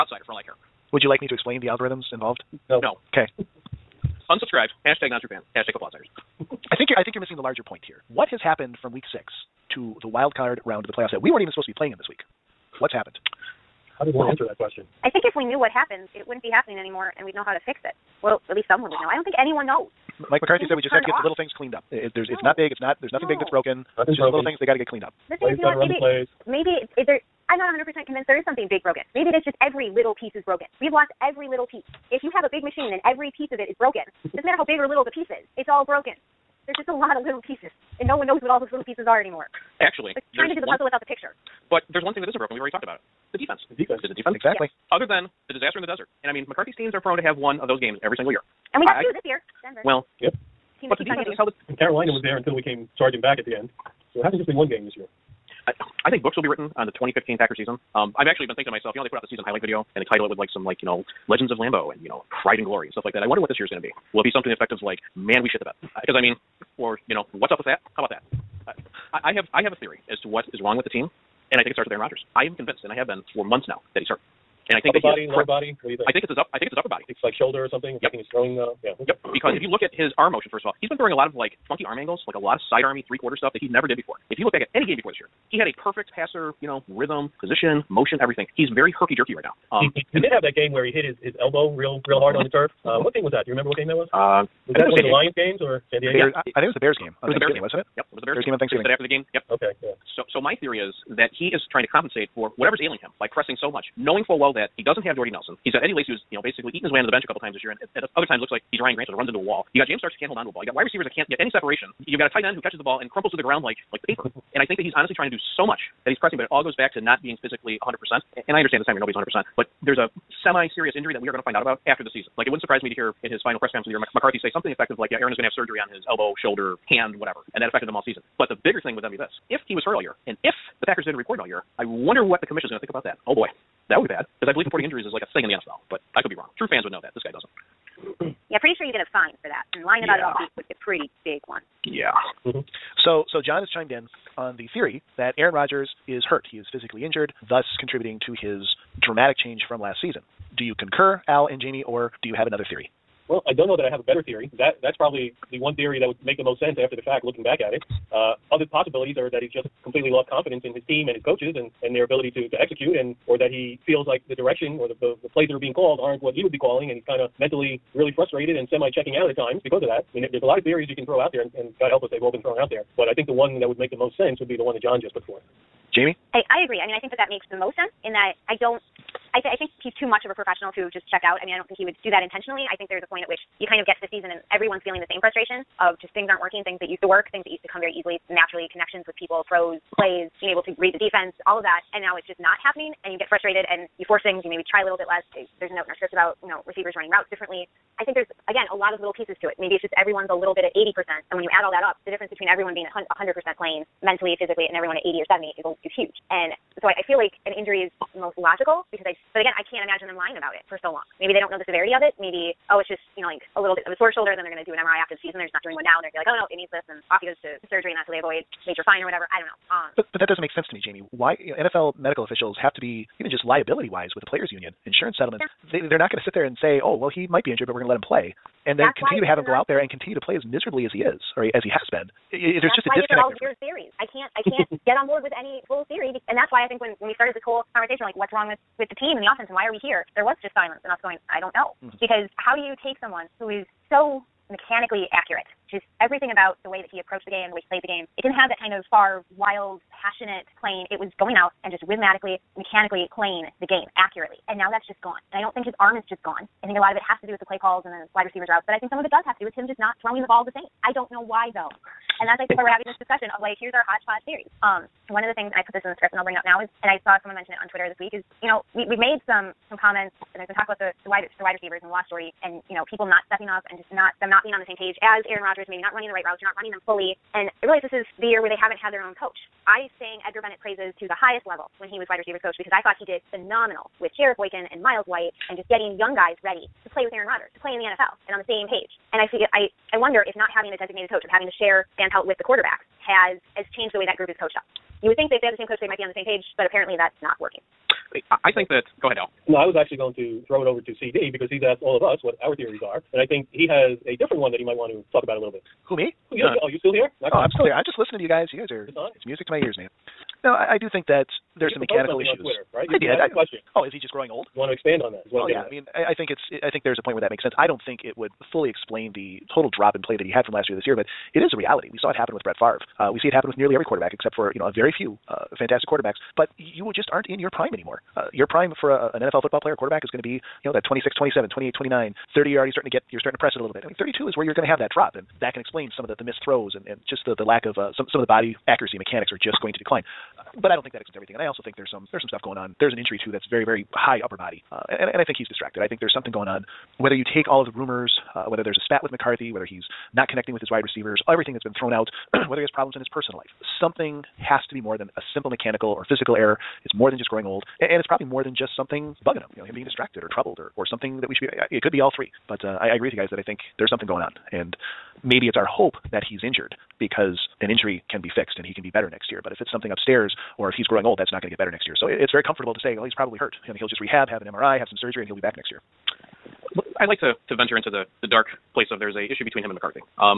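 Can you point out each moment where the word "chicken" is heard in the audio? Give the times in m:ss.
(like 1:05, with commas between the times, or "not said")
not said.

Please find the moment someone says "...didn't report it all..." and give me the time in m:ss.
2:11.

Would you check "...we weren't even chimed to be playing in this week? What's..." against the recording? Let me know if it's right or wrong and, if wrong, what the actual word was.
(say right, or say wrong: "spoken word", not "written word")
wrong: "supposed", not "chimed".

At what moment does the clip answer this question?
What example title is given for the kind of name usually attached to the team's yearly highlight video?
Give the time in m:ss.
1:01.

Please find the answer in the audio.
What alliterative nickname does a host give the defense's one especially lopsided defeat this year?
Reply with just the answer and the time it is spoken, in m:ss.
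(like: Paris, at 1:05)
disaster in the desert, at 0:45.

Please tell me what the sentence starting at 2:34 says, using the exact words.
That that's probably the one theory that would make the most sense after the fact, looking back at it.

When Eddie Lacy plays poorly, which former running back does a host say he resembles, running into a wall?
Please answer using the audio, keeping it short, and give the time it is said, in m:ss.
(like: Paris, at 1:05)
Ryan Grant, at 1:48.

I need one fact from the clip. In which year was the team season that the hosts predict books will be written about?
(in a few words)
2015.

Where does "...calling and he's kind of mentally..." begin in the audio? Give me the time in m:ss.
2:46.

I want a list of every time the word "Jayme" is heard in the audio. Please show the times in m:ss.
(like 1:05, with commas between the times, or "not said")
2:31, 2:55, 3:40.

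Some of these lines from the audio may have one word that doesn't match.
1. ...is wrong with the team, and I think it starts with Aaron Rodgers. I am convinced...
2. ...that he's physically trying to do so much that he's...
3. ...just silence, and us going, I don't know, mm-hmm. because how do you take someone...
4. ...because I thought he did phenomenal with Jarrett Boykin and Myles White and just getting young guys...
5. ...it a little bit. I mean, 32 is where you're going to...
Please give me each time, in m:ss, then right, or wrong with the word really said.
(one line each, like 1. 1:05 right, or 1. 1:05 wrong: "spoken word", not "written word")
1. 1:10 right
2. 1:54 wrong: "honestly", not "physically"
3. 4:00 right
4. 4:42 right
5. 5:33 right.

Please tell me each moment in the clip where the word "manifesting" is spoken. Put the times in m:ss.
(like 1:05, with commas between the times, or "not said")
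not said.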